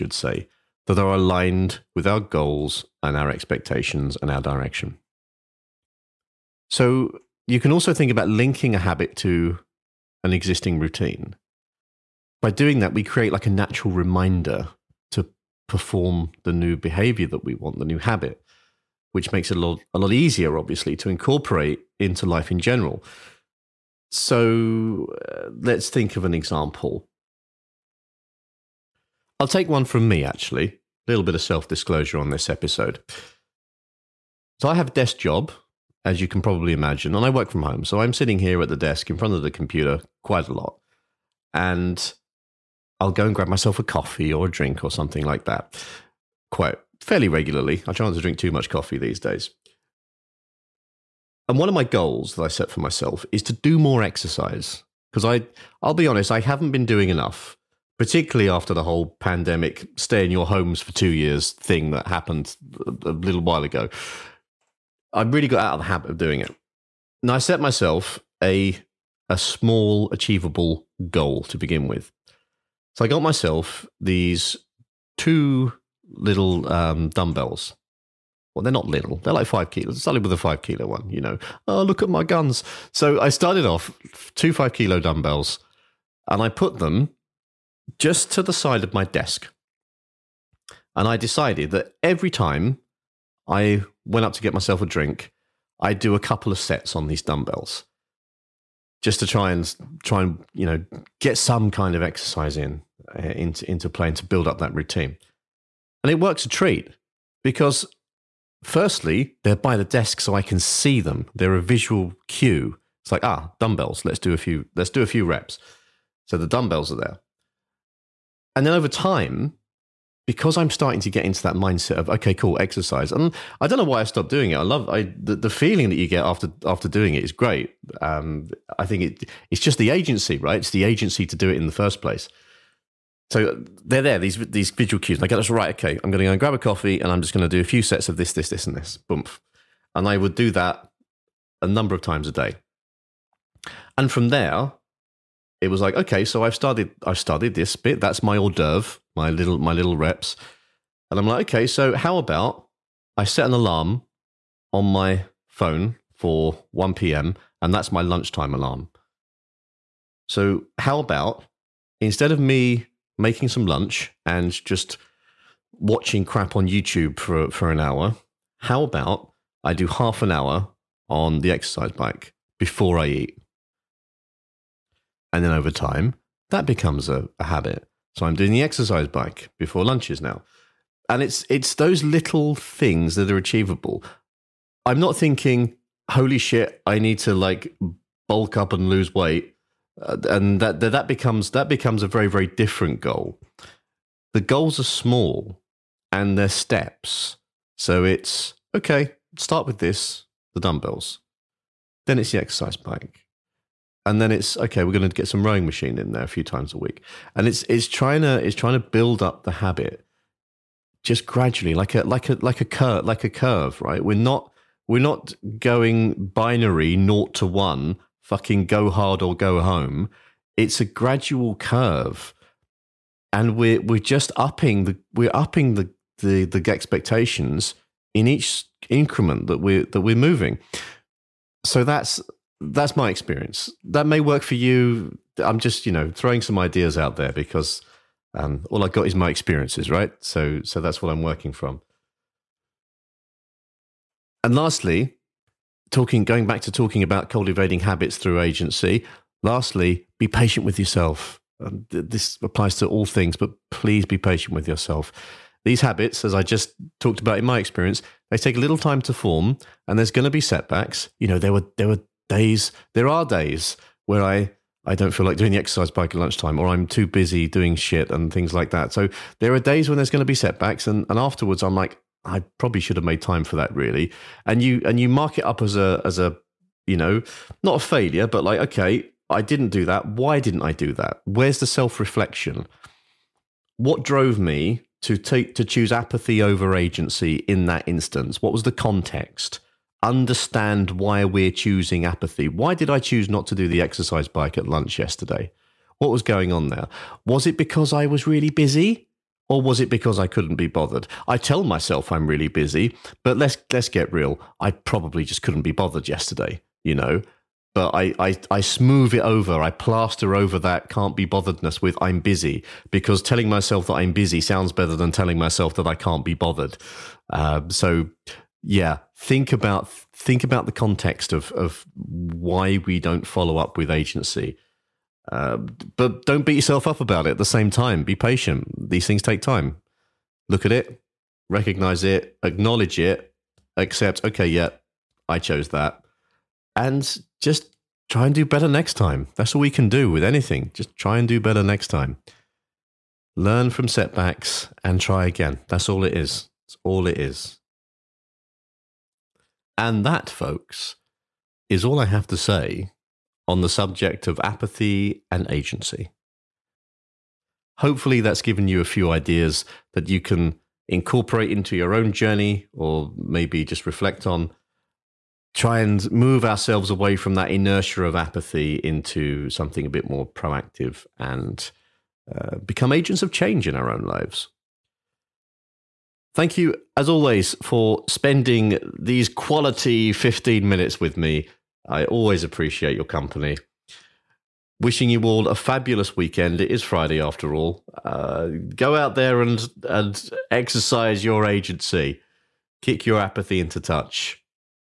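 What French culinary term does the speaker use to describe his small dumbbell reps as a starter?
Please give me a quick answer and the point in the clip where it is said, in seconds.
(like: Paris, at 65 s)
Hors d'oeuvre, at 148 s.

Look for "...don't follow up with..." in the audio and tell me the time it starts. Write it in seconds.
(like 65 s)
322 s.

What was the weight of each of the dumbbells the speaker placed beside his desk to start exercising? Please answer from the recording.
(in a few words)
5 kilos.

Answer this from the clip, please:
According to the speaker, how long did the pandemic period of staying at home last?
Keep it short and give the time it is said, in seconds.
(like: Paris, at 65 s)
2 years, at 60 s.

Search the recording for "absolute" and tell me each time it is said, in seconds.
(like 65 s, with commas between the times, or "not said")
not said.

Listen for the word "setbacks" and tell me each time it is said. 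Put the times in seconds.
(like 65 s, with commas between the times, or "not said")
260 s, 270 s, 343 s.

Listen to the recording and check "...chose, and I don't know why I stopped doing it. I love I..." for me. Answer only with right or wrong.
wrong.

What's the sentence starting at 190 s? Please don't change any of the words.
Uh, and that, that that becomes that becomes a very very different goal.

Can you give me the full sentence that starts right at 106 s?
And it works a treat because firstly, they're by the desk so I can see them.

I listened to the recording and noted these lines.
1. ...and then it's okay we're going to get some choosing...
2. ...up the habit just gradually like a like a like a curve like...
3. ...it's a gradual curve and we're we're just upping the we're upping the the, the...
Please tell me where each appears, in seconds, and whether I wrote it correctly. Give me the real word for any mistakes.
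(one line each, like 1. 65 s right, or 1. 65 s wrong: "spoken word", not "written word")
1. 204 s wrong: "rowing", not "choosing"
2. 209 s right
3. 220 s right.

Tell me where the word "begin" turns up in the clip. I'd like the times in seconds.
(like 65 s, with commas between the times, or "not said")
71 s.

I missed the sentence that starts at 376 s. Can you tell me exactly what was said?
Thank you, as always, for spending these quality 15 minutes with me.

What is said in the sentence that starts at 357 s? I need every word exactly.
Hopefully, that's given you a few ideas that you can incorporate into your own journey or maybe just reflect on.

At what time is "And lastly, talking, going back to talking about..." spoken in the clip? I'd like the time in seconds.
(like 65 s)
244 s.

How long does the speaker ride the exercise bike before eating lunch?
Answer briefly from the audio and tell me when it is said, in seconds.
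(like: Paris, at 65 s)
Half an hour, at 169 s.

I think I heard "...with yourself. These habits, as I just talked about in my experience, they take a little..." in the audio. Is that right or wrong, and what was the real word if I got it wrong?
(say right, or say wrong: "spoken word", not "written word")
right.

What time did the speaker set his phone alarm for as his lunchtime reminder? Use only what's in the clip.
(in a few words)
1 p.m.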